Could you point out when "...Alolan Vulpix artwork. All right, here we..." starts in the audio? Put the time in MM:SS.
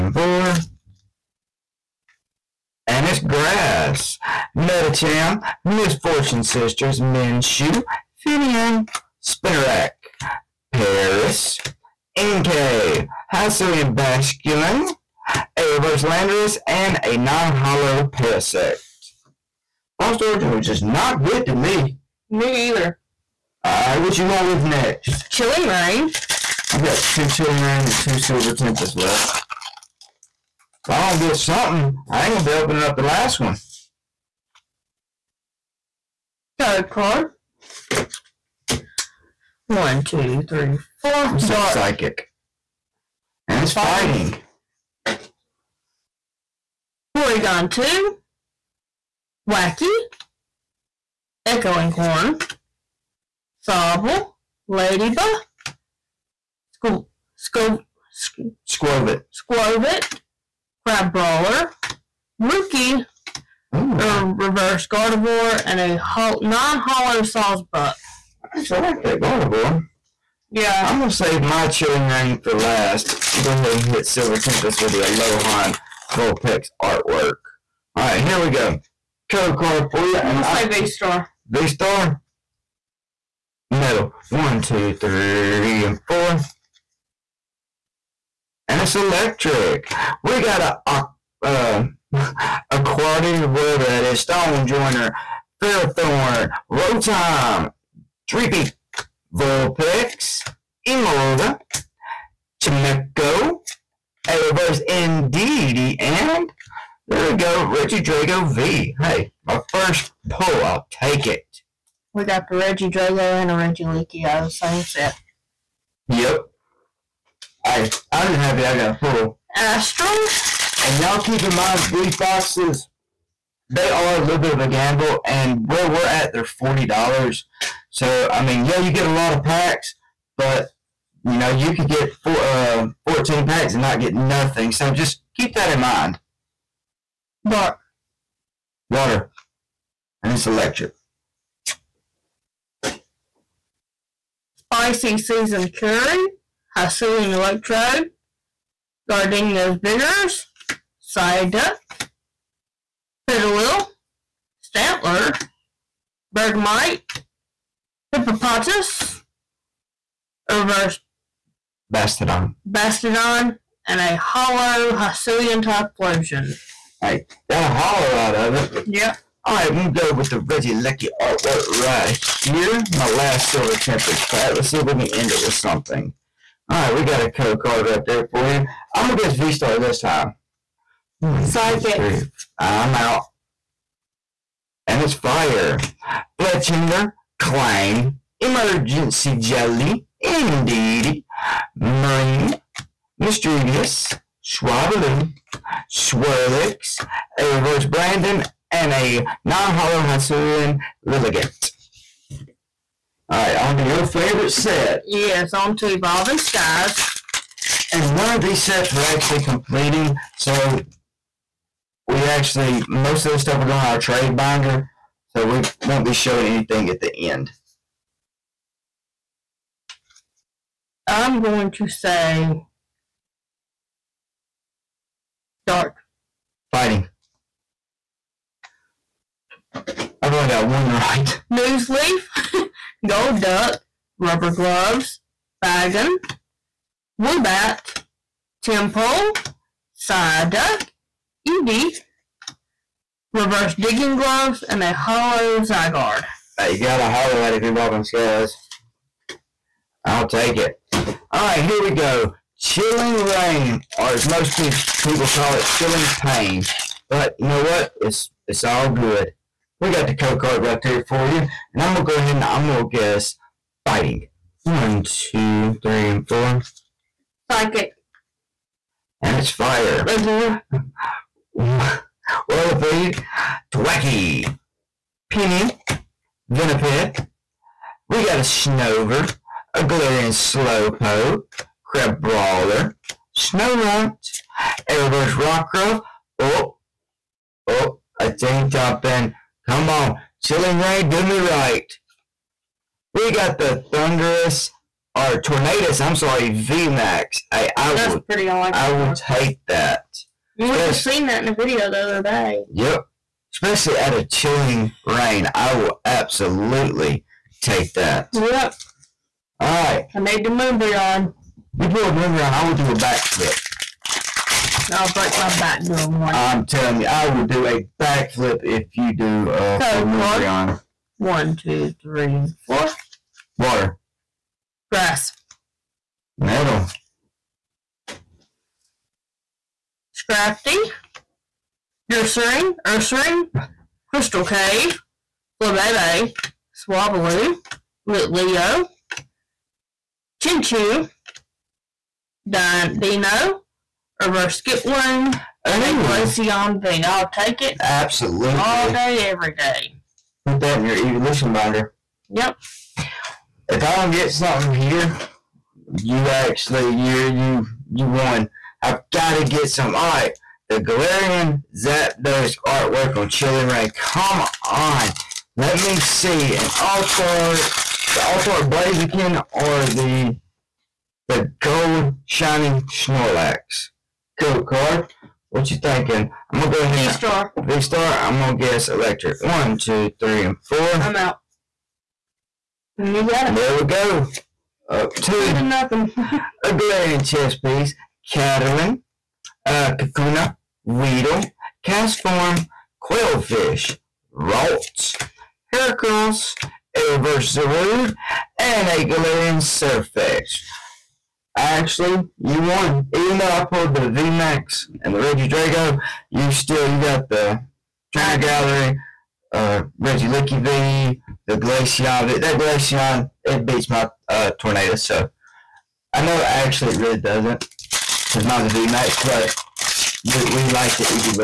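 01:15.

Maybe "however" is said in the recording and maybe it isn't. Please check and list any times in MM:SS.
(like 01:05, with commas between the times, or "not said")
not said.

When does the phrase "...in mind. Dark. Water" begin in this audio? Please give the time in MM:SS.
02:15.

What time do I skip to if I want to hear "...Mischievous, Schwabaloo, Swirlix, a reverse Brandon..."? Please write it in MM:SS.
03:13.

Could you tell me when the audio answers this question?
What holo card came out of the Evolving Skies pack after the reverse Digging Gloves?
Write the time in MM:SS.
04:05.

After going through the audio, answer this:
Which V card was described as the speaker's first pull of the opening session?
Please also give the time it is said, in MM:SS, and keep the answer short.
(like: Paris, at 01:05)
Regidrago V, at 01:47.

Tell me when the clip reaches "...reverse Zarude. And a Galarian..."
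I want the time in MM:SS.
06:37.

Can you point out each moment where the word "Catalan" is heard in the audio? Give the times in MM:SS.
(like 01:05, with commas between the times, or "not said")
06:28.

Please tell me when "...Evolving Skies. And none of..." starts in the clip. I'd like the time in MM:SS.
03:25.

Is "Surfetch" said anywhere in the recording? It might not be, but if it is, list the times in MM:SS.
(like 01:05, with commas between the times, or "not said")
06:39.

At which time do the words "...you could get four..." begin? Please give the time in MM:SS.
02:11.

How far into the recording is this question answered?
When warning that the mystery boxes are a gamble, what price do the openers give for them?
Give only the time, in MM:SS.
02:06.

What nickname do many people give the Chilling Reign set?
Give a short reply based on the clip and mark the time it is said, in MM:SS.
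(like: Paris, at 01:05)
Chilling Pain, at 04:15.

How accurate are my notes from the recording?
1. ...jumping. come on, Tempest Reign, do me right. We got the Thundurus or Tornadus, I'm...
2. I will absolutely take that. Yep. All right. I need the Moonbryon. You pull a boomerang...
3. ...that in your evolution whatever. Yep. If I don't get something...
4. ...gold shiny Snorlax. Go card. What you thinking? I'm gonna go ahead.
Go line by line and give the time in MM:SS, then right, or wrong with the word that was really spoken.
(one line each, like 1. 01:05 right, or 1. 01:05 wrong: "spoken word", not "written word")
1. 04:48 wrong: "Chilling", not "Tempest"
2. 05:05 right
3. 05:50 wrong: "binder", not "whatever"
4. 06:11 right.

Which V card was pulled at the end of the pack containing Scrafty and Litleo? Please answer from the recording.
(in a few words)
Glaceon V.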